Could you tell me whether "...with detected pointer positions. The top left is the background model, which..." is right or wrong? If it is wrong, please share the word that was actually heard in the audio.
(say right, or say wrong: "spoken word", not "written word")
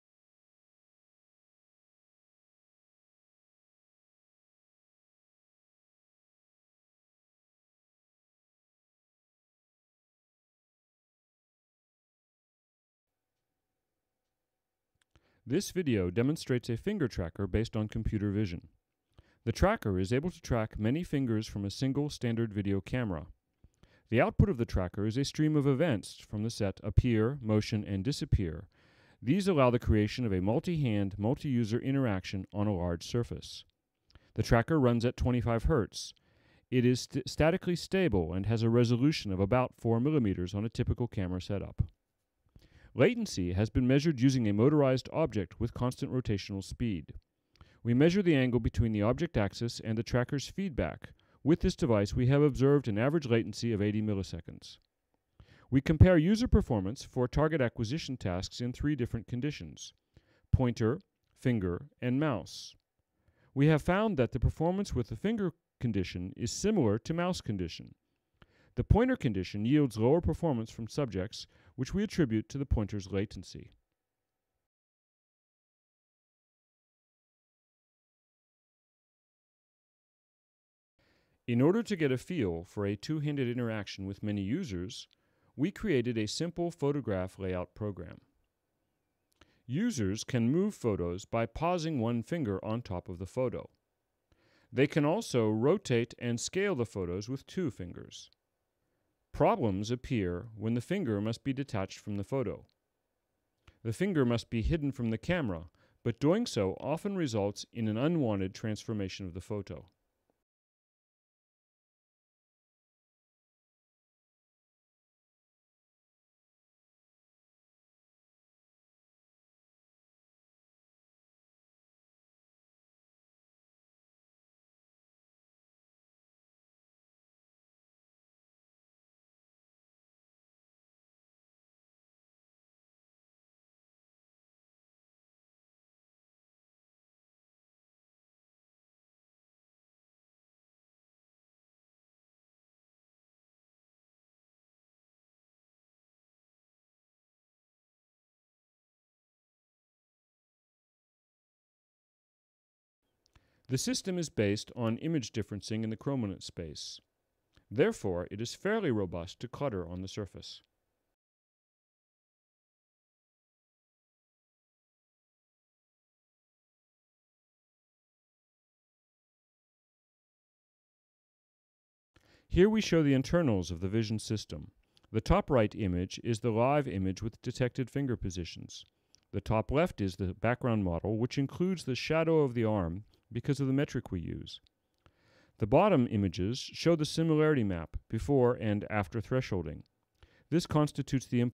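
wrong: "finger", not "pointer".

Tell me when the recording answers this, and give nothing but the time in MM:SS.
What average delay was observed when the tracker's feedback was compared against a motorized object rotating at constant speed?
00:53.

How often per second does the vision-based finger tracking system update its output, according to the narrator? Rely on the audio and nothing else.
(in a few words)
25 Hz.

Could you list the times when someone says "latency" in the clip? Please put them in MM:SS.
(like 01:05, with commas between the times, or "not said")
00:42, 00:53, 01:13.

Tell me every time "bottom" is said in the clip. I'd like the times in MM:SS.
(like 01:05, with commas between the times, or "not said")
03:05.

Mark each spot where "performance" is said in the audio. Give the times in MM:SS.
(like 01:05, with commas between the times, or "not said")
00:56, 01:04, 01:10.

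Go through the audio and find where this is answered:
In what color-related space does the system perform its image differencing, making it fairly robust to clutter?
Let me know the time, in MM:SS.
02:35.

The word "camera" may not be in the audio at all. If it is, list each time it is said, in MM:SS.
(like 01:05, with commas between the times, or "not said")
00:22, 00:41, 01:45.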